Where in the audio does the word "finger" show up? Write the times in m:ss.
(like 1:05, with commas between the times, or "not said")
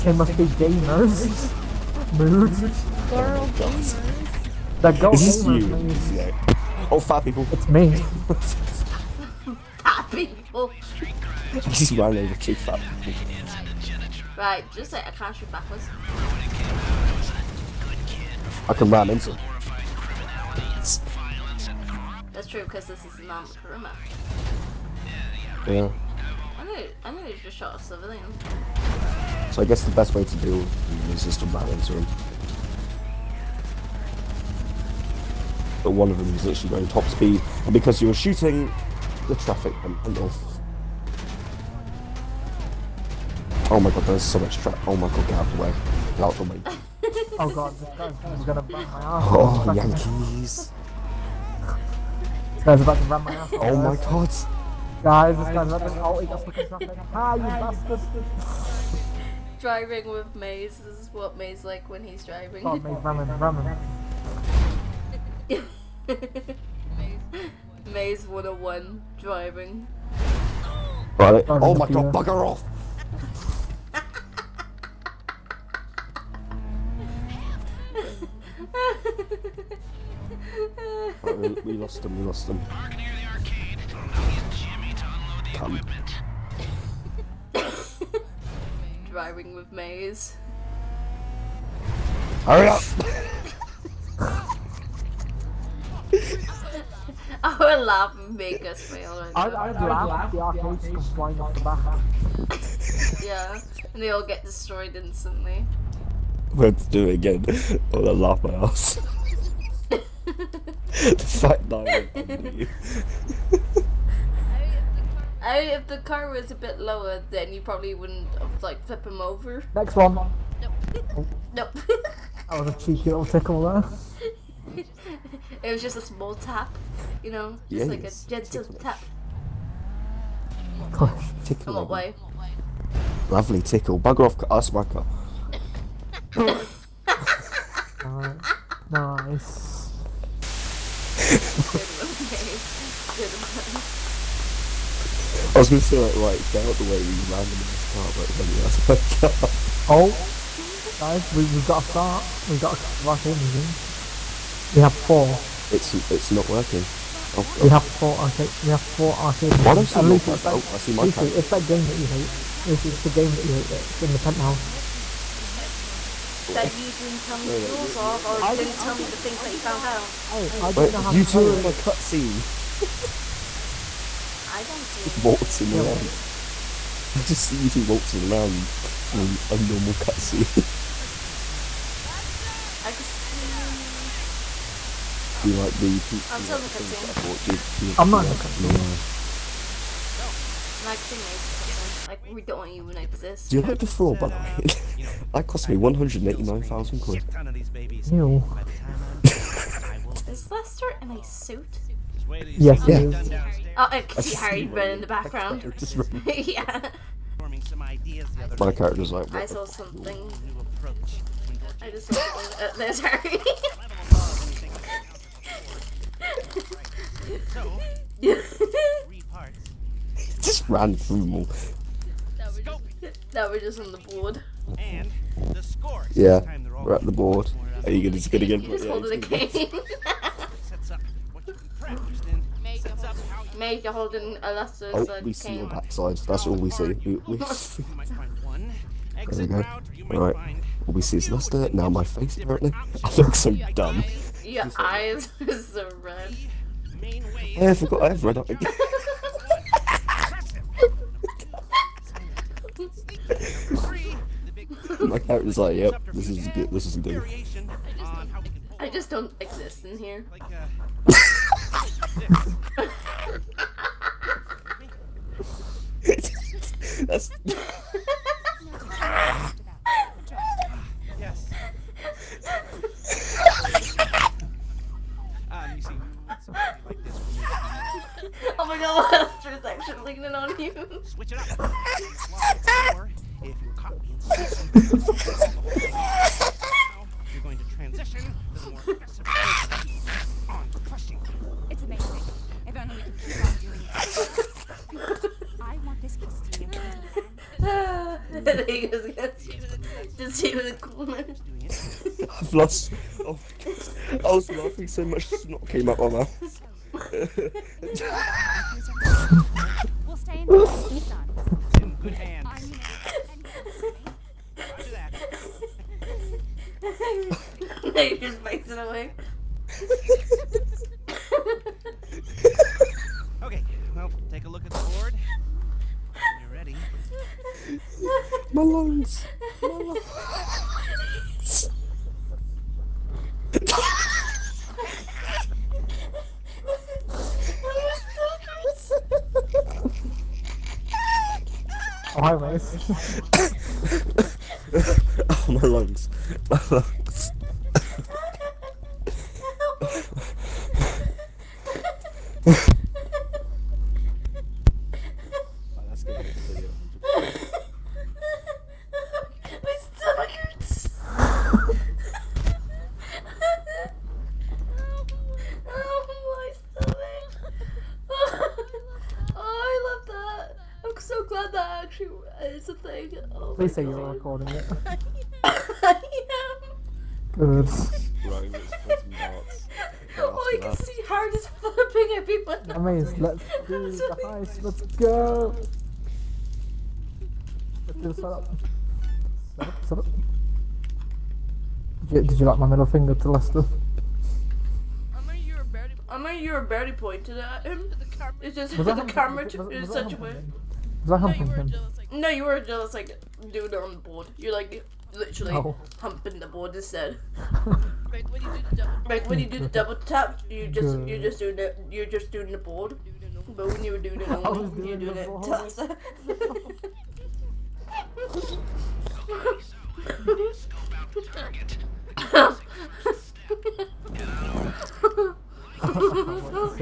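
6:32.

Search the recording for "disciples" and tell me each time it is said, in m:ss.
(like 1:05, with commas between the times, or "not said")
not said.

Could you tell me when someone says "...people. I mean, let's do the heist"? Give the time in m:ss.
6:22.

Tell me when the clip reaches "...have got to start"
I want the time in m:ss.
2:31.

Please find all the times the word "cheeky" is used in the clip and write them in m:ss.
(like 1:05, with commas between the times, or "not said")
2:02.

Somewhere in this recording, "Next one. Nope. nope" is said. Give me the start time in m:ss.
1:59.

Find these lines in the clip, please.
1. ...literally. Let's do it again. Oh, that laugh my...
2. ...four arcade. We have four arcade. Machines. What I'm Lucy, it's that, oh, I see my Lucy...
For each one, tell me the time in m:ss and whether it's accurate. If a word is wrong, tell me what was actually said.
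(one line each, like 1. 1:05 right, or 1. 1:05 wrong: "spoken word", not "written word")
1. 1:44 wrong: "instantly", not "literally"
2. 2:37 right.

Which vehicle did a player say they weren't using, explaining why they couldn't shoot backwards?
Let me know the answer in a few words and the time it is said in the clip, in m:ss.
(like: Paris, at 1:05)
Kuruma, at 0:23.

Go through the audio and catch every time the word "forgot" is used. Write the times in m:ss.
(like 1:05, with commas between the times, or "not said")
4:07.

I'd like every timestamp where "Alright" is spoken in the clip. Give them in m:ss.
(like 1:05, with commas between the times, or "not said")
4:00.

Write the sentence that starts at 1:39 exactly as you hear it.
I'd, I'd, i laugh if the arcades come flying off the back.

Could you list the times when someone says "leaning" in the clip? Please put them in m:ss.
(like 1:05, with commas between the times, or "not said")
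4:40.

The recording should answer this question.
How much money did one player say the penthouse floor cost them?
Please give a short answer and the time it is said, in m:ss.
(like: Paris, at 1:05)
189,000 quid, at 3:15.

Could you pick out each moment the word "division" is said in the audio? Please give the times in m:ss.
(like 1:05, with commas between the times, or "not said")
not said.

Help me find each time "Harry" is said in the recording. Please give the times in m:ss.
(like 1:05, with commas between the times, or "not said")
3:24, 3:32.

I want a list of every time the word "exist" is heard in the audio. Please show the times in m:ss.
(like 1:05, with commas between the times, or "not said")
3:12, 4:19.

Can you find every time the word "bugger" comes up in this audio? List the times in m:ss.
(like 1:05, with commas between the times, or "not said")
1:12, 2:13.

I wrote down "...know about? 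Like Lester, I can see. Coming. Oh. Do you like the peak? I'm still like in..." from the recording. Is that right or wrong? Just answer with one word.
right.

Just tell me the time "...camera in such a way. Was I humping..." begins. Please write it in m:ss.
6:39.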